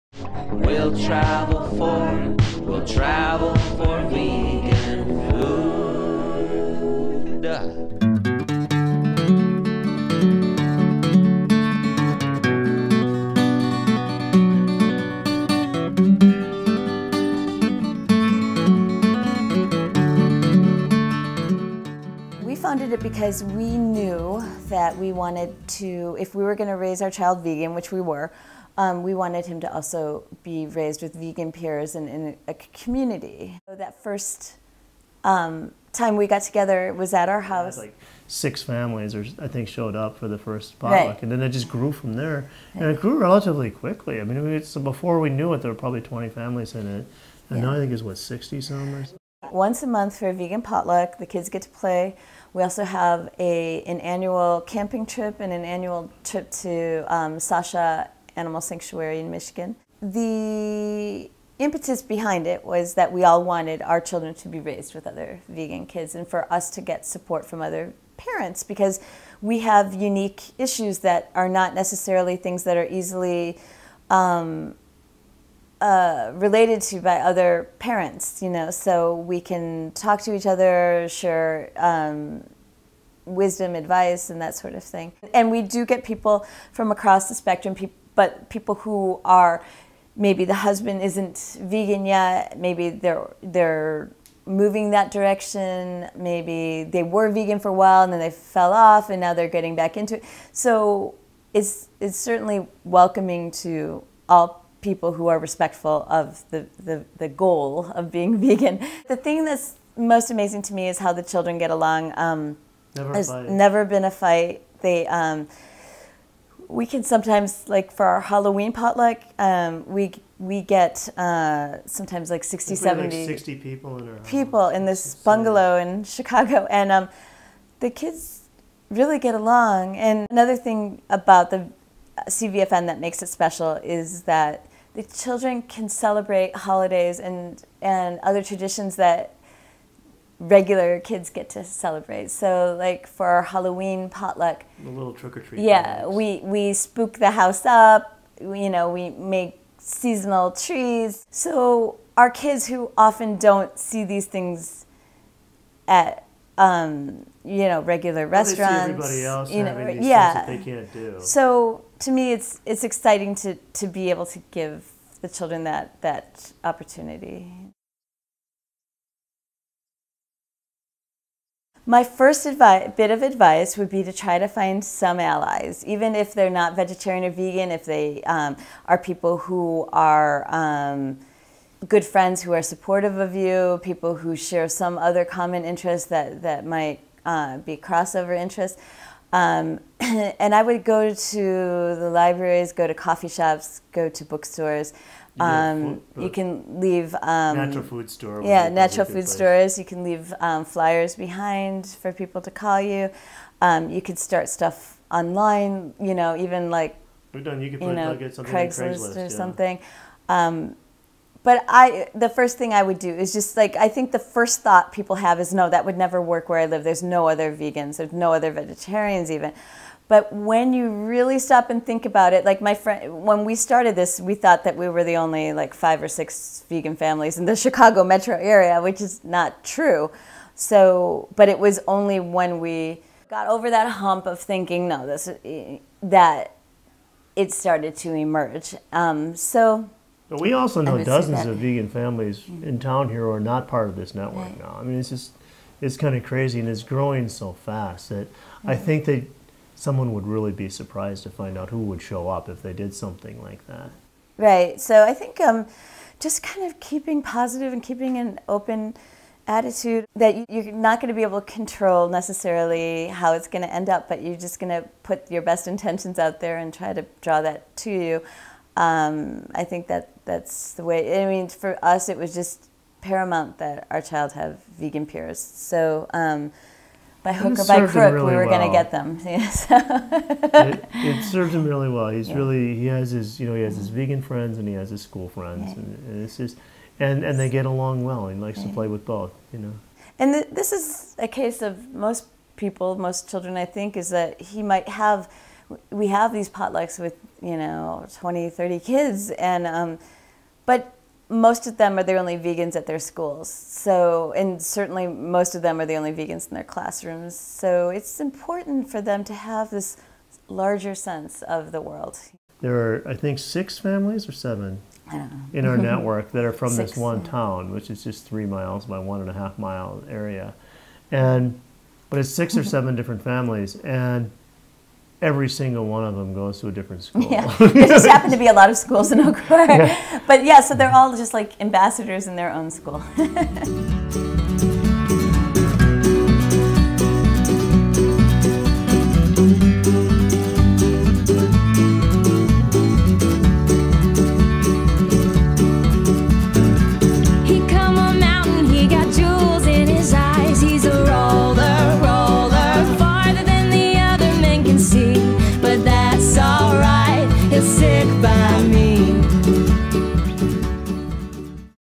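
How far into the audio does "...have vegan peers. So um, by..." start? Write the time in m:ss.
4:34.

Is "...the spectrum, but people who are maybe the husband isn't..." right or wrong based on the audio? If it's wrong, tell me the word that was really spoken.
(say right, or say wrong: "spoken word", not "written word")
right.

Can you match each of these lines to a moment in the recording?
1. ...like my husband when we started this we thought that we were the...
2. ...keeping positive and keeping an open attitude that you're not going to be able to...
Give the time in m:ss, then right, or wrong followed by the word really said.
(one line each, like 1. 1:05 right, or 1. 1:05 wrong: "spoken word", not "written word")
1. 3:42 wrong: "friend", not "husband"
2. 4:16 right.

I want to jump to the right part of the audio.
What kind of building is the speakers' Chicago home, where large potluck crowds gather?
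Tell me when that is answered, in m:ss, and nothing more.
2:05.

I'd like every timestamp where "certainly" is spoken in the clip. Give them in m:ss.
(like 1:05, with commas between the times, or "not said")
1:42, 5:04.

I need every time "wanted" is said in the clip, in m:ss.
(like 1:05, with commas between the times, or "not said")
0:25, 0:29, 1:03.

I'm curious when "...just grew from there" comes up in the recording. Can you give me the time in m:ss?
0:41.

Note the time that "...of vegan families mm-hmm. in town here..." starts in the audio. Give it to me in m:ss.
4:01.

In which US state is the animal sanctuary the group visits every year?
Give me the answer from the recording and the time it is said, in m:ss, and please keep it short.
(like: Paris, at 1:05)
Michigan, at 0:59.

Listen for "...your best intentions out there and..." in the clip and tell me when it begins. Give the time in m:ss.
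4:25.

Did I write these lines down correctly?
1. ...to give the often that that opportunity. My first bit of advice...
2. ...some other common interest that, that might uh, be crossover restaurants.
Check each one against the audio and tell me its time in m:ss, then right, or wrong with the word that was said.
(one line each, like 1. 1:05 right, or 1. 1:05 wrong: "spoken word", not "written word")
1. 2:44 wrong: "children", not "often"
2. 3:04 wrong: "interests", not "restaurants".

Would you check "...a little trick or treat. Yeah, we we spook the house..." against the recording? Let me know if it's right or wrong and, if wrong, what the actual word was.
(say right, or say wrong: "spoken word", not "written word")
right.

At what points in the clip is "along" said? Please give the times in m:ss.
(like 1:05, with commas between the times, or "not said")
1:51, 2:09, 4:47.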